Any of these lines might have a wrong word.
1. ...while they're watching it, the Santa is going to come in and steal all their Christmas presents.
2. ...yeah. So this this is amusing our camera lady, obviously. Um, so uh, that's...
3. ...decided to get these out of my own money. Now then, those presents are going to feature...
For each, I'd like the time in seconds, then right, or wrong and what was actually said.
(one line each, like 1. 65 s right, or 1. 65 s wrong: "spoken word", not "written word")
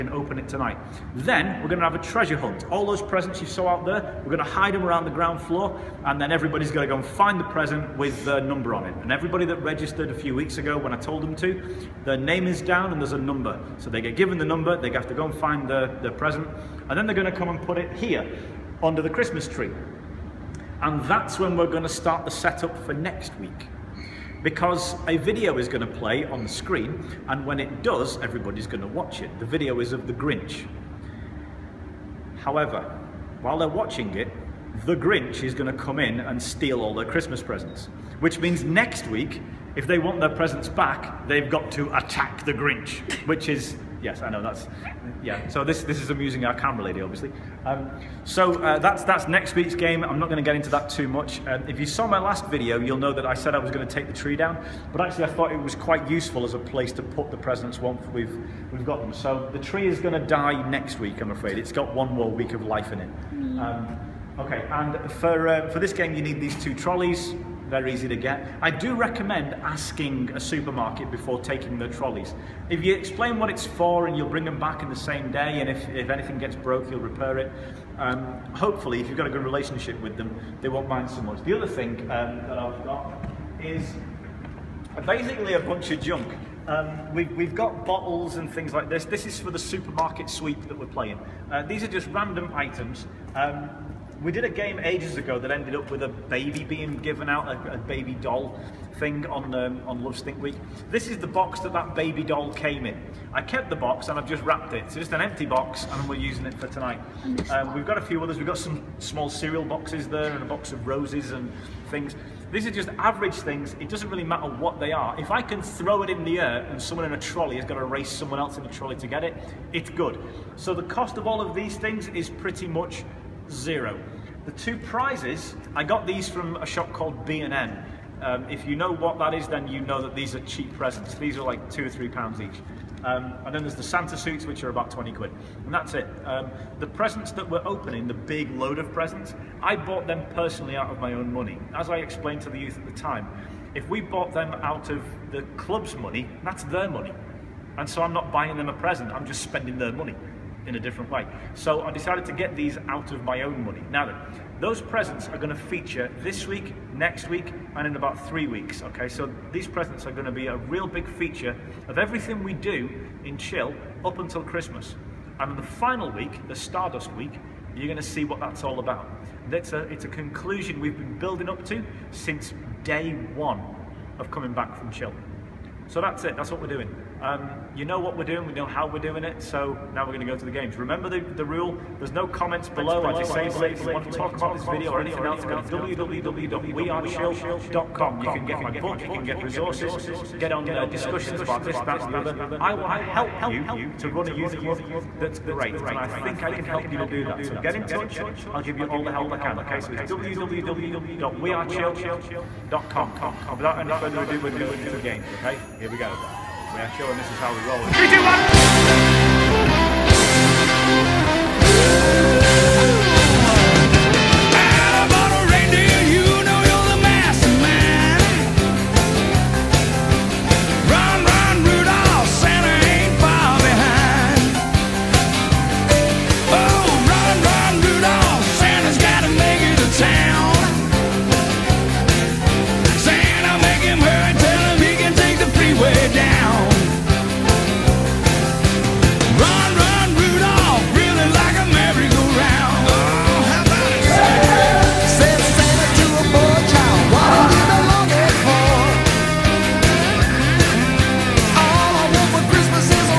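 1. 33 s wrong: "Grinch", not "Santa"
2. 45 s right
3. 151 s right.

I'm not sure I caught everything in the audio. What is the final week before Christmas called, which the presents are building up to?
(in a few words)
Stardust week.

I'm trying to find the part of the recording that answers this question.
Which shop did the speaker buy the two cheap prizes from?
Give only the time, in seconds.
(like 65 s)
127 s.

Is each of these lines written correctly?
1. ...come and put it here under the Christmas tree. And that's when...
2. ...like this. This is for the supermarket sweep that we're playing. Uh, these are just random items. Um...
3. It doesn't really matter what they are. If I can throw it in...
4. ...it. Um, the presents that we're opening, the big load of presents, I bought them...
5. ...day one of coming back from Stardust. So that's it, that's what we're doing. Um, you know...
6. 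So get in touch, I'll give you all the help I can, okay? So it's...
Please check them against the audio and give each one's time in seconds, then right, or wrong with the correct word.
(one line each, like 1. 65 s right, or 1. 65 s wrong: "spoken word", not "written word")
1. 17 s right
2. 88 s right
3. 113 s right
4. 135 s right
5. 172 s wrong: "Chill", not "Stardust"
6. 197 s right.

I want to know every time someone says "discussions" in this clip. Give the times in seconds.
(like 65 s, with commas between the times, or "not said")
190 s.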